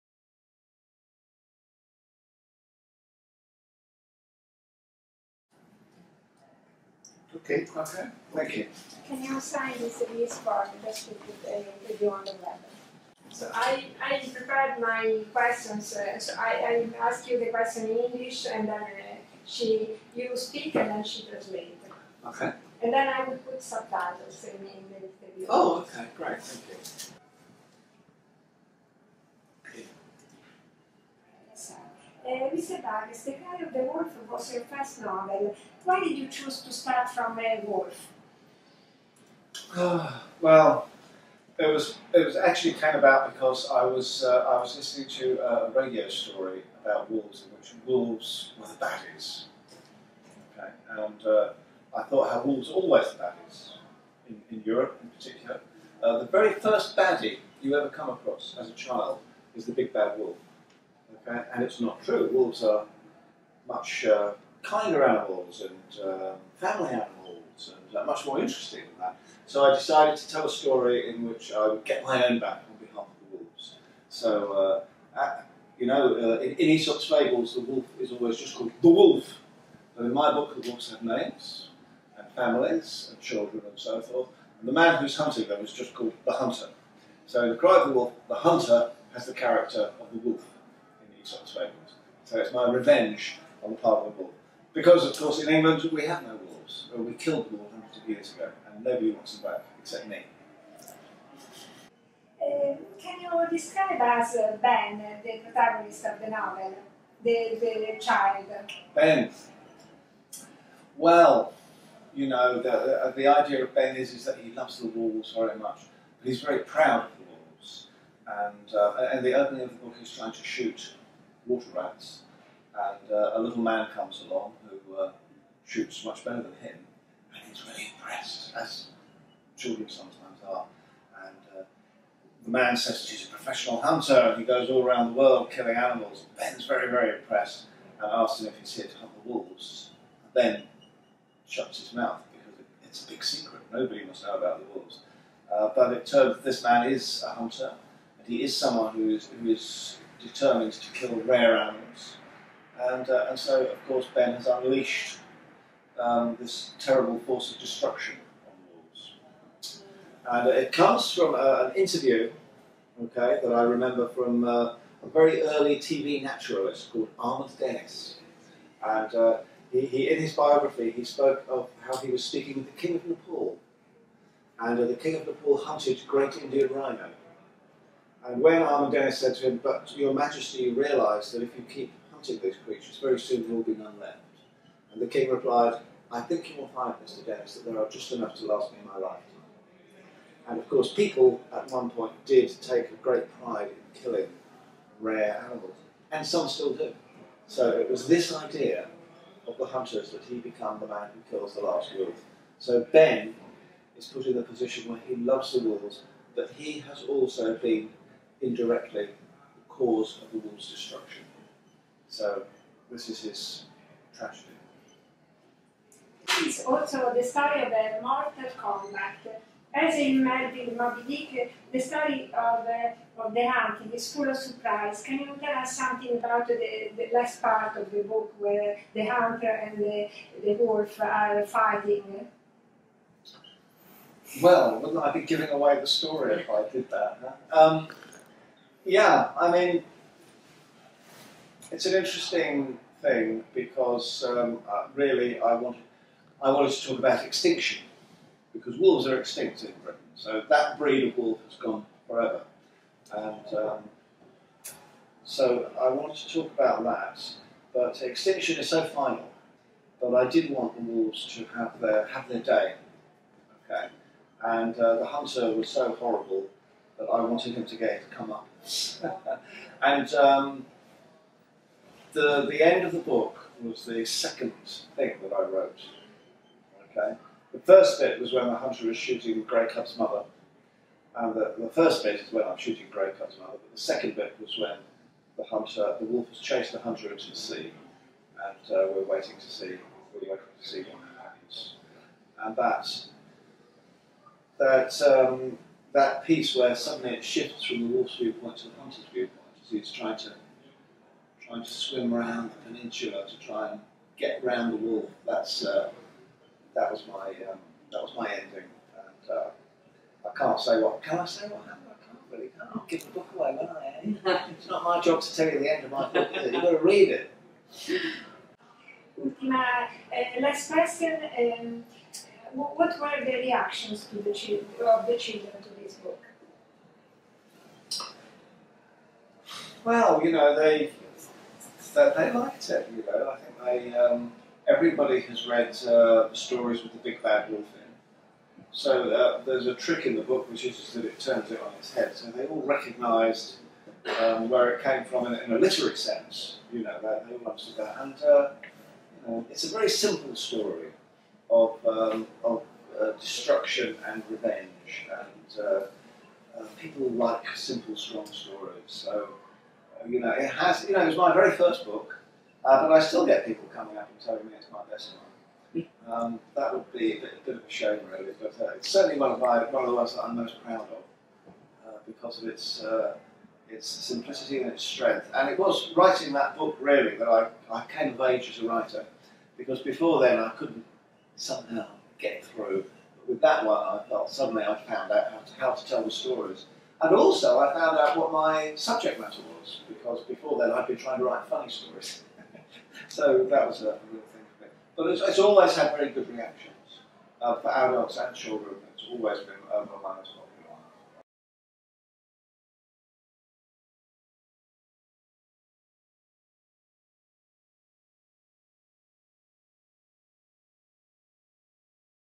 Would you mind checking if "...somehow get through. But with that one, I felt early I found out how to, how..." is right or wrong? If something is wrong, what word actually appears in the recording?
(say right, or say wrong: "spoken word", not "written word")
wrong: "suddenly", not "early".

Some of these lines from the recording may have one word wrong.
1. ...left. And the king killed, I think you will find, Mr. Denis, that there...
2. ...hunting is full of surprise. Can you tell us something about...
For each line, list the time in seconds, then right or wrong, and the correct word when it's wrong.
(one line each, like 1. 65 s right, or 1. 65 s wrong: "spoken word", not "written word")
1. 183 s wrong: "replied", not "killed"
2. 223 s right.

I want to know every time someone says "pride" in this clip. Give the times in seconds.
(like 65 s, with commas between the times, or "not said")
193 s.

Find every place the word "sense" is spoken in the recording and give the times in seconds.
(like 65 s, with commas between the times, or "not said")
345 s.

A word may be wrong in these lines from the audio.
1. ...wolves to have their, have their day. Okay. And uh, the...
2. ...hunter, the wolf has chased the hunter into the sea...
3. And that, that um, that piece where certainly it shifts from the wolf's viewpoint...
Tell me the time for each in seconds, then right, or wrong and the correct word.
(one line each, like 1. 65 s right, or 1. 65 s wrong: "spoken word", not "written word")
1. 260 s right
2. 285 s right
3. 292 s wrong: "suddenly", not "certainly".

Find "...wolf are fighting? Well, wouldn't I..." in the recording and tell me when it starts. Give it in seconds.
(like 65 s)
230 s.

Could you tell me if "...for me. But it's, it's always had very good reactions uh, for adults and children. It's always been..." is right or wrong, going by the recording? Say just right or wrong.
right.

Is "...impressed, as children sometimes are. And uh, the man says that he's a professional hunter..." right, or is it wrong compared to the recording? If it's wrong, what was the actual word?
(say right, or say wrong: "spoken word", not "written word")
right.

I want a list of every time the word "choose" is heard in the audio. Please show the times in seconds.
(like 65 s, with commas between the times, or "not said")
36 s.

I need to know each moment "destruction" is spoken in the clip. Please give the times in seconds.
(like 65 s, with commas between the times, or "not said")
157 s, 210 s, 353 s.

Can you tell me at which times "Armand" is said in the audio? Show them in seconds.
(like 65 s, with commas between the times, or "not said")
167 s, 178 s.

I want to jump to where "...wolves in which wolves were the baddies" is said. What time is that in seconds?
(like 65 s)
47 s.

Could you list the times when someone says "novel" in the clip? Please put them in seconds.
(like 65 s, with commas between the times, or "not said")
35 s, 106 s.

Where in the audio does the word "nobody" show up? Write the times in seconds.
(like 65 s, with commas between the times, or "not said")
98 s, 143 s.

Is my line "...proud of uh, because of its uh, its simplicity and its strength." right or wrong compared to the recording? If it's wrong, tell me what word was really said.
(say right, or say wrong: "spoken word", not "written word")
right.